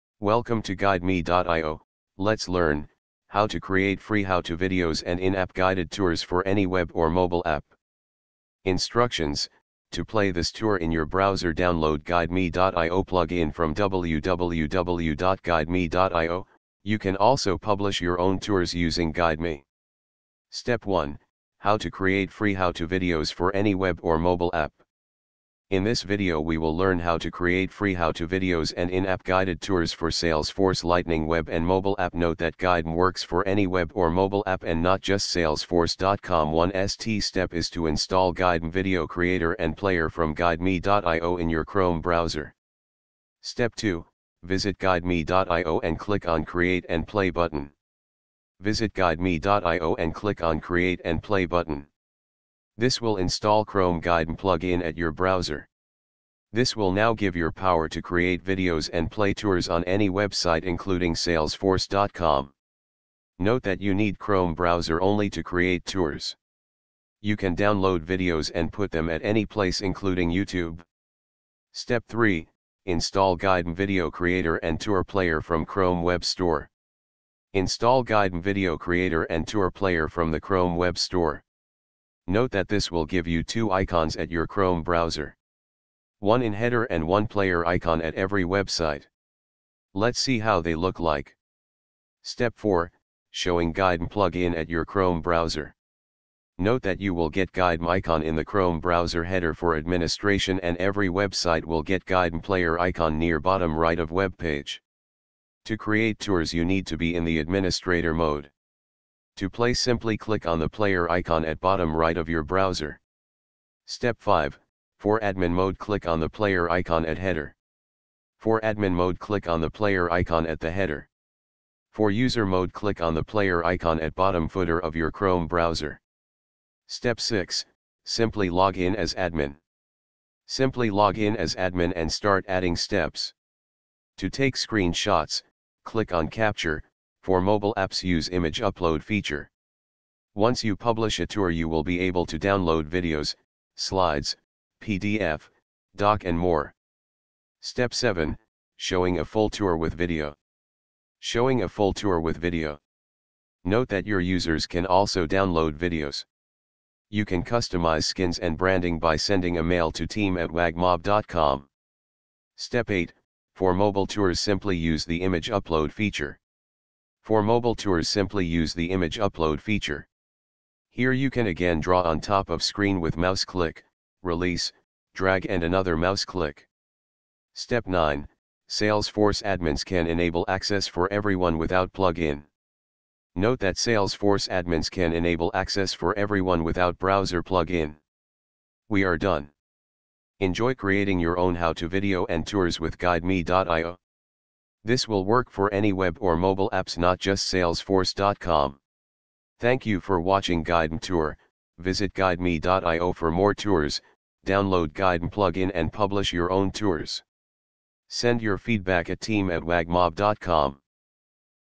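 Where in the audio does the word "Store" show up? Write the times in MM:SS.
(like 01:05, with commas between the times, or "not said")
01:16, 01:20.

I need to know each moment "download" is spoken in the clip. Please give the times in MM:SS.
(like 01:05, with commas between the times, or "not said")
00:11, 01:07, 02:22, 02:35, 03:24.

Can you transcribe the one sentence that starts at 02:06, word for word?
Step 6, simply log in as admin.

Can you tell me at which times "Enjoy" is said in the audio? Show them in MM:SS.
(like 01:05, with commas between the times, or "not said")
03:10.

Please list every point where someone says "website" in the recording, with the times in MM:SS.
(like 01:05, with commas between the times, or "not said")
01:00, 01:28, 01:41.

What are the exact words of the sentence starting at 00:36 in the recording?
One ST step is to install GuideMe Video Creator and Player from guideme.io in your Chrome browser.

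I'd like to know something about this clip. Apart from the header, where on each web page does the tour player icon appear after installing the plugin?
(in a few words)
Near bottom right.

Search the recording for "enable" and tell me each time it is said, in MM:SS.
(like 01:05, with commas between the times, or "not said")
03:00, 03:05.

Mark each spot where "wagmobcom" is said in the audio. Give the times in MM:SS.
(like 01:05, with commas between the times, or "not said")
02:40, 03:29.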